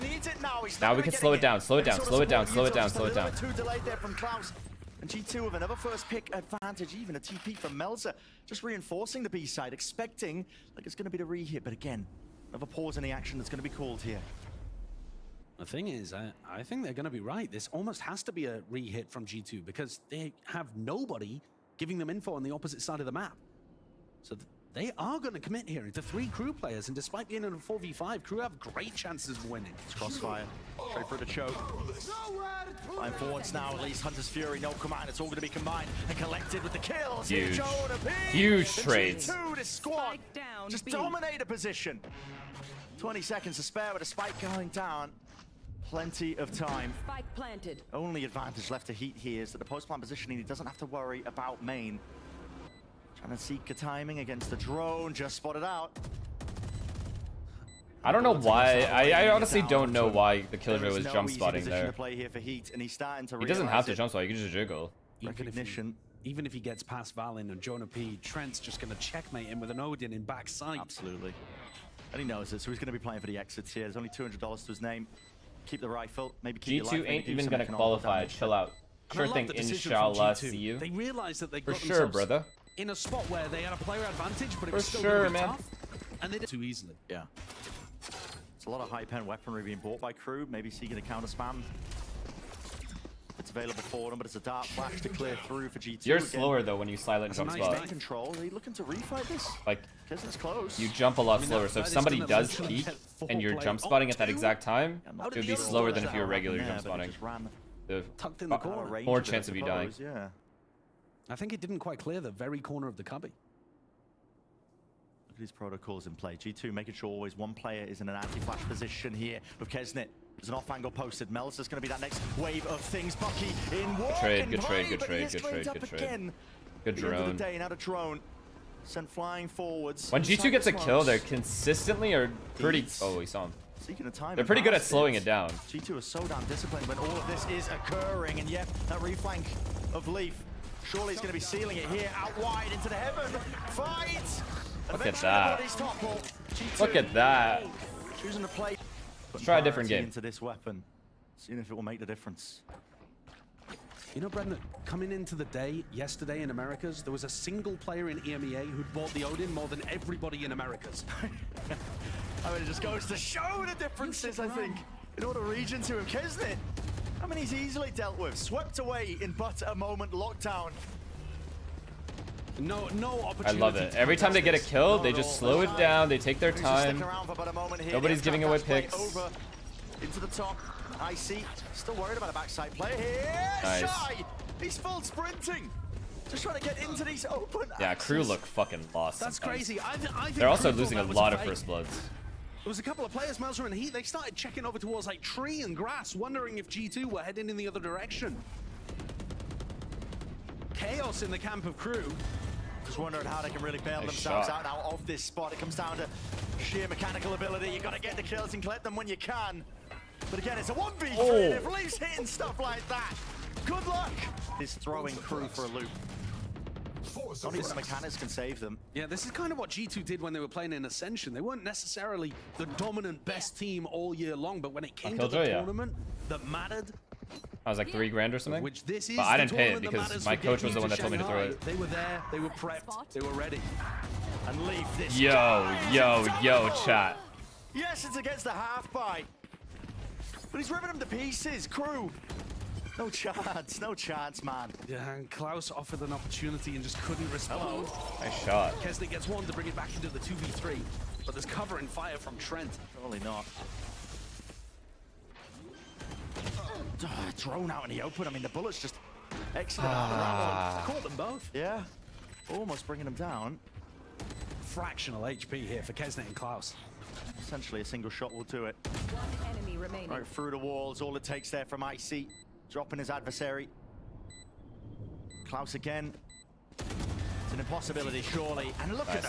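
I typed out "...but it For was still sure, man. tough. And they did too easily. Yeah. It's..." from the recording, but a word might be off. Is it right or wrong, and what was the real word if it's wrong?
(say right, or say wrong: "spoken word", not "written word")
right.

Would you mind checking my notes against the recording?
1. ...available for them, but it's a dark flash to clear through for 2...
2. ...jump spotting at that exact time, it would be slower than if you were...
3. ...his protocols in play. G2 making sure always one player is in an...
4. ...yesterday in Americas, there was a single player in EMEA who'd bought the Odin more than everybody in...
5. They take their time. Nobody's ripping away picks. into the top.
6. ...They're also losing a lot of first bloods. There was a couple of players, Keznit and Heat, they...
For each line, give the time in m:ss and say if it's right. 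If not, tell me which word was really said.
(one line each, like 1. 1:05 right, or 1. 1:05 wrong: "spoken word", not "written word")
1. 1:33 right
2. 1:43 right
3. 1:55 right
4. 2:35 right
5. 2:56 wrong: "giving", not "ripping"
6. 3:10 wrong: "Mazra", not "Keznit".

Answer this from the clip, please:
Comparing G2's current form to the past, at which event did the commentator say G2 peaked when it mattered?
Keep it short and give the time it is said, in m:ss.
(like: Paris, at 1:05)
Ascension, at 3:40.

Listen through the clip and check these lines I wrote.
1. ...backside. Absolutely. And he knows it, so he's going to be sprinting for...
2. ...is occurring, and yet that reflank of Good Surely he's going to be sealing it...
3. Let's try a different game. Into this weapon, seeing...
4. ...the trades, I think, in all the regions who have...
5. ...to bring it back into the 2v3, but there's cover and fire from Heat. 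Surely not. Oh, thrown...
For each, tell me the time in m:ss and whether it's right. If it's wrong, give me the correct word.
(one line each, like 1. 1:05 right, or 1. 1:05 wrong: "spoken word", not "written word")
1. 1:10 wrong: "playing", not "sprinting"
2. 2:17 wrong: "Leaf", not "Good"
3. 2:29 right
4. 2:43 wrong: "differences", not "trades"
5. 4:09 wrong: "Trent", not "Heat".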